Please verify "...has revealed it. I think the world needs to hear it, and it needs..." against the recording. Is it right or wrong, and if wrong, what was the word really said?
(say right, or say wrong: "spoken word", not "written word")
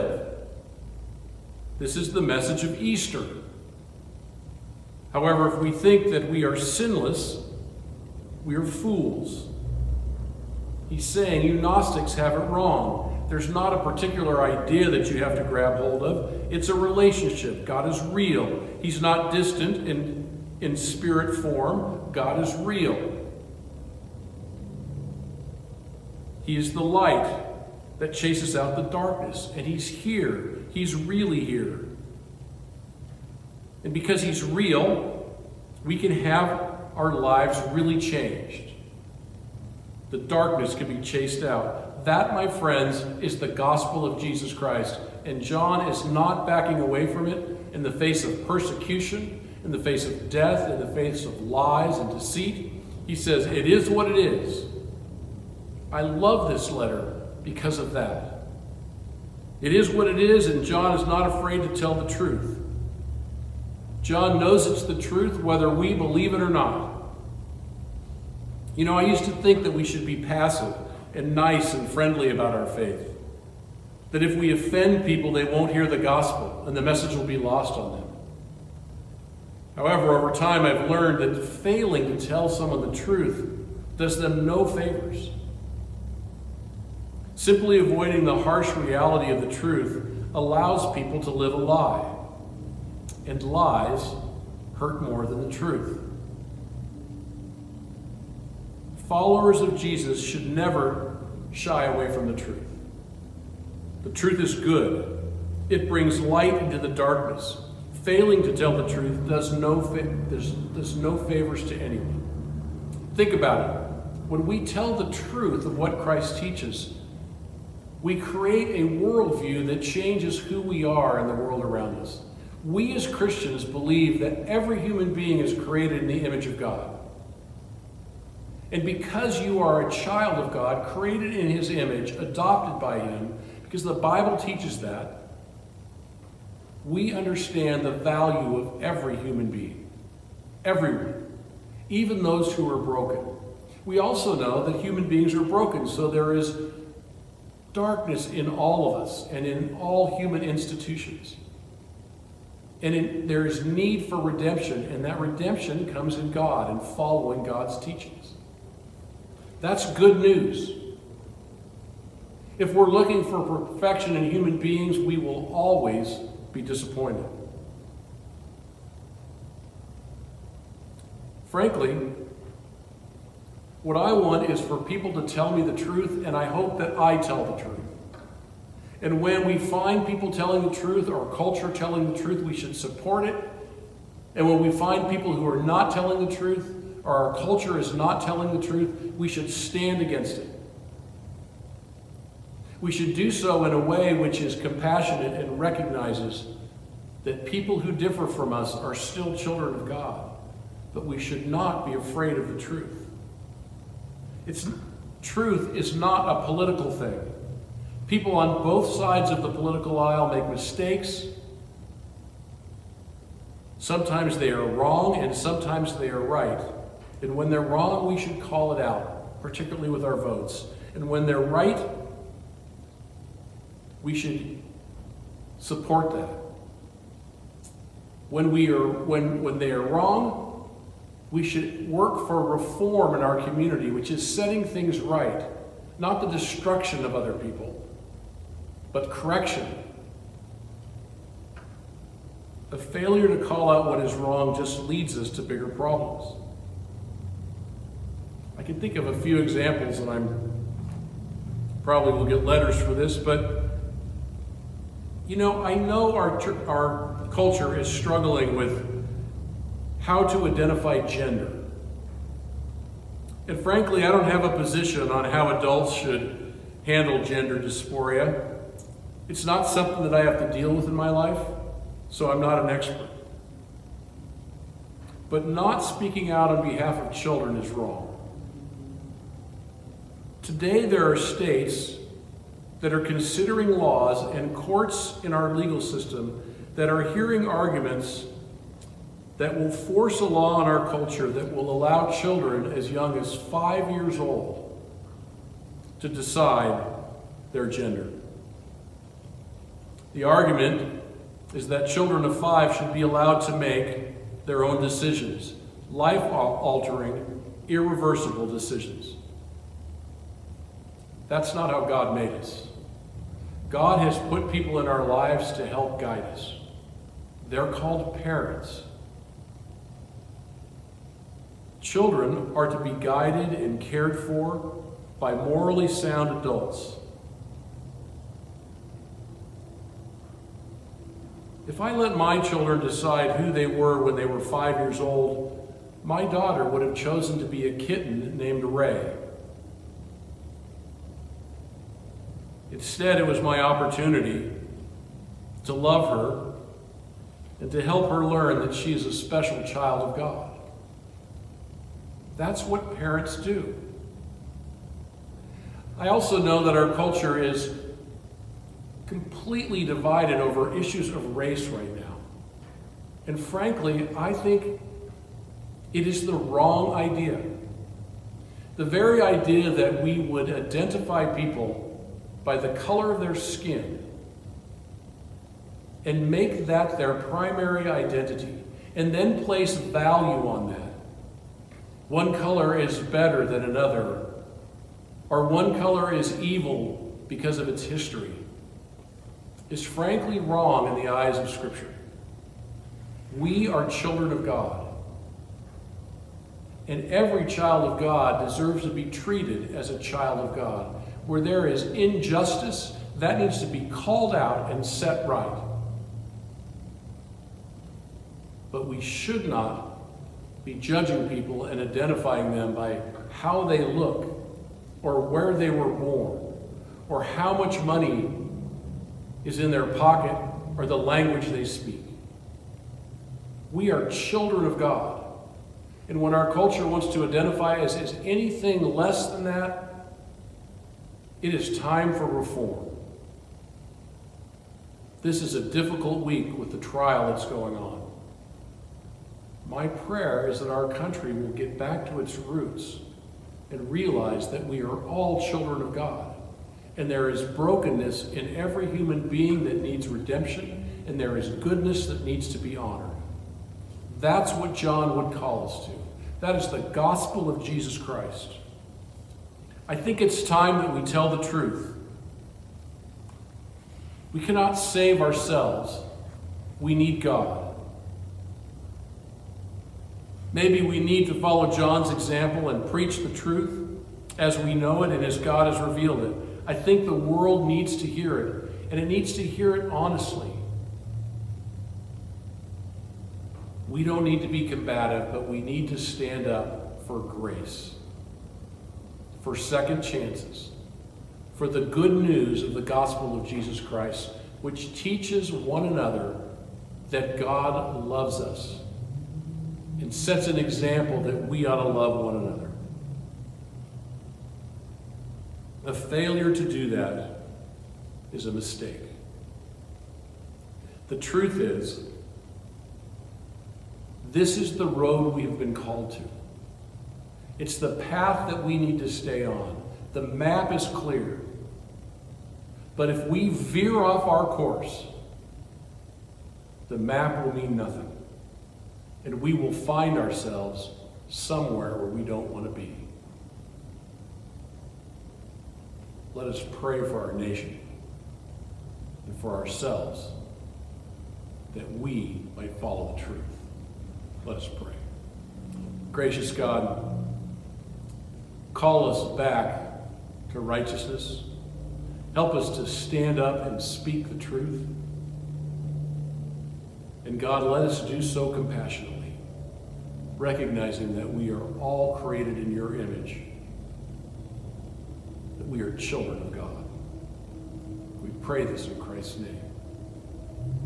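right.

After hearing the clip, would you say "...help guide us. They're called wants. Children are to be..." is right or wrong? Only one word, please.
wrong.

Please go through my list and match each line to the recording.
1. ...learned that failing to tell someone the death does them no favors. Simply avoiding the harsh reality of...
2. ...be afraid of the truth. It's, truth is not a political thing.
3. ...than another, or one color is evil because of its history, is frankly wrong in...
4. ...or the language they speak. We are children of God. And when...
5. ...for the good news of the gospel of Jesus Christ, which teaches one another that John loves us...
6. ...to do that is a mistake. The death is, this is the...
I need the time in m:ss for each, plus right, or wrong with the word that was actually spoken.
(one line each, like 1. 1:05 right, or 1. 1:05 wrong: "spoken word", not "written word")
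1. 1:20 wrong: "truth", not "death"
2. 3:21 right
3. 6:23 right
4. 7:00 right
5. 8:11 wrong: "God", not "John"
6. 8:26 wrong: "truth", not "death".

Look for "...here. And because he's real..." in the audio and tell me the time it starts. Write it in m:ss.
0:31.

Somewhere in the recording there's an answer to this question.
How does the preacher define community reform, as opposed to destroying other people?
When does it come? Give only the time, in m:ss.
3:54.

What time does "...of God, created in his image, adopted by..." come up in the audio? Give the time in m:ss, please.
2:10.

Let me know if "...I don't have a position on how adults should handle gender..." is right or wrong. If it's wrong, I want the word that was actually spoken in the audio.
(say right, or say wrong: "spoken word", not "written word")
right.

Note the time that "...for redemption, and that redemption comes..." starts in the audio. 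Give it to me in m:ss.
2:34.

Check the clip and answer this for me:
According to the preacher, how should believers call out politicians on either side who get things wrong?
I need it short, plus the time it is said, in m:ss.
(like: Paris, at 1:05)
votes, at 3:40.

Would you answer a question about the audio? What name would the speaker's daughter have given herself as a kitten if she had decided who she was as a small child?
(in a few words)
Ray.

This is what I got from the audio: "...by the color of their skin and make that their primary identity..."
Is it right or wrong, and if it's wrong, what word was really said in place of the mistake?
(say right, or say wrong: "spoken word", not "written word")
right.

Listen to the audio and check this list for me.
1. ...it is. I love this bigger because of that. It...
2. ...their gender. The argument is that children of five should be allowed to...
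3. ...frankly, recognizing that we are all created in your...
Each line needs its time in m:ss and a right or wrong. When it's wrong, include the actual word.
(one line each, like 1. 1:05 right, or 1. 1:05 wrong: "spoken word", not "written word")
1. 0:54 wrong: "letter", not "bigger"
2. 4:57 right
3. 9:18 wrong: "compassionately", not "frankly".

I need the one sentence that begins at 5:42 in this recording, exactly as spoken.
Instead, it was my opportunity to love her and to help her learn that she is a special child of God.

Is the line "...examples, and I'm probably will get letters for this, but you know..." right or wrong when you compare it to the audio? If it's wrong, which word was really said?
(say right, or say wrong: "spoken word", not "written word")
right.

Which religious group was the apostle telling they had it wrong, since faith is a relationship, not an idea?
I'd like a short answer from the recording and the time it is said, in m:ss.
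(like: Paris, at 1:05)
Gnostics, at 0:11.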